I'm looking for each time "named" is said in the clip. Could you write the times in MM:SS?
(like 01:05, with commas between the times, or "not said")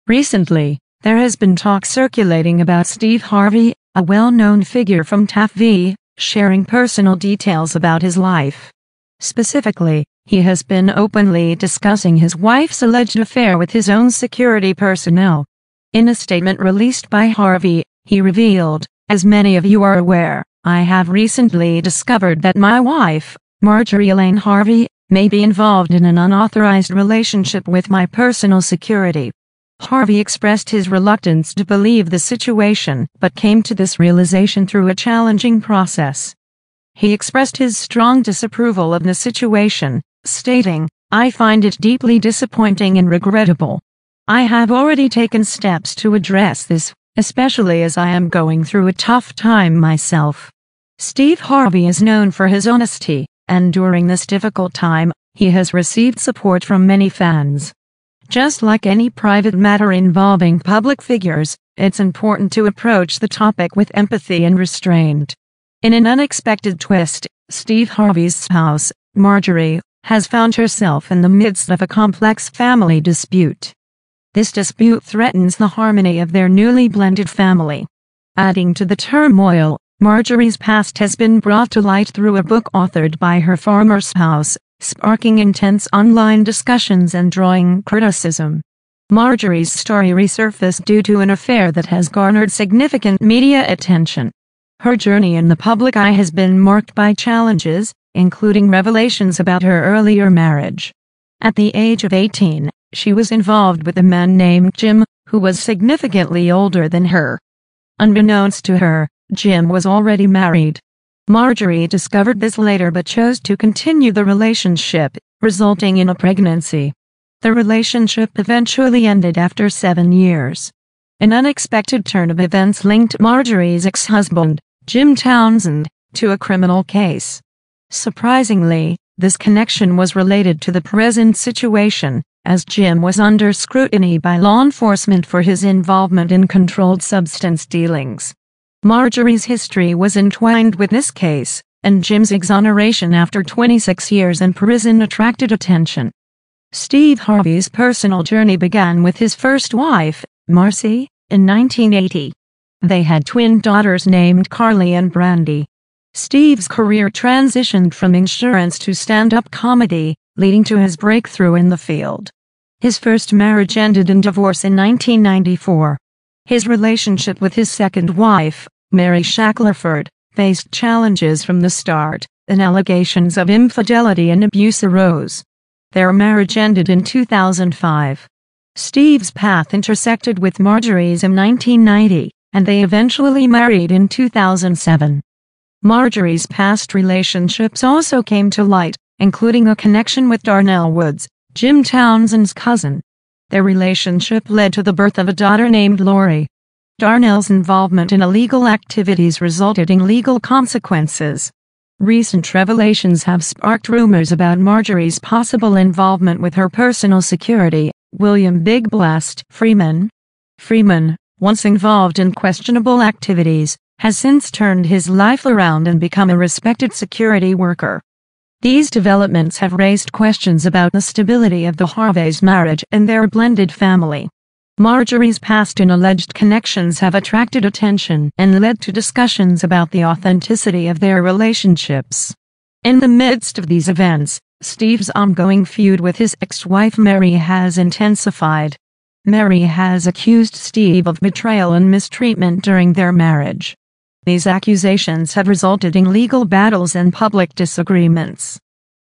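01:44, 02:34, 03:15.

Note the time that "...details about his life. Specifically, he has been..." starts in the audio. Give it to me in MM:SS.
00:07.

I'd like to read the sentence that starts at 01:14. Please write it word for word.
This dispute threatens the harmony of their newly blended family.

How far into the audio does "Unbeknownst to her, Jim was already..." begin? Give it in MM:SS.
01:47.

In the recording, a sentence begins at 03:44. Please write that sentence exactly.
Marjorie's past and alleged connections have attracted attention and led to discussions about the authenticity of their relationships.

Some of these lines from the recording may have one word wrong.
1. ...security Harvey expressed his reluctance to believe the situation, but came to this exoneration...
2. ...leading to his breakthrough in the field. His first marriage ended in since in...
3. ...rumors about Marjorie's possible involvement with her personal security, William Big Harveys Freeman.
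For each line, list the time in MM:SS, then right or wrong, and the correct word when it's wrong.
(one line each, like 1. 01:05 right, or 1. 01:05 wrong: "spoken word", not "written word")
1. 00:28 wrong: "realization", not "exoneration"
2. 02:40 wrong: "divorce", not "since"
3. 03:23 wrong: "Black", not "Harveys".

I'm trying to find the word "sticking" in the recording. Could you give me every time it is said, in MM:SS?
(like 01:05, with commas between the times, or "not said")
not said.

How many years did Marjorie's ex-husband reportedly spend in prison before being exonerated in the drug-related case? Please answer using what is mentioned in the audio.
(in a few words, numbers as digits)
26.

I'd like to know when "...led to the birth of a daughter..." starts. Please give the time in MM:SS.
03:14.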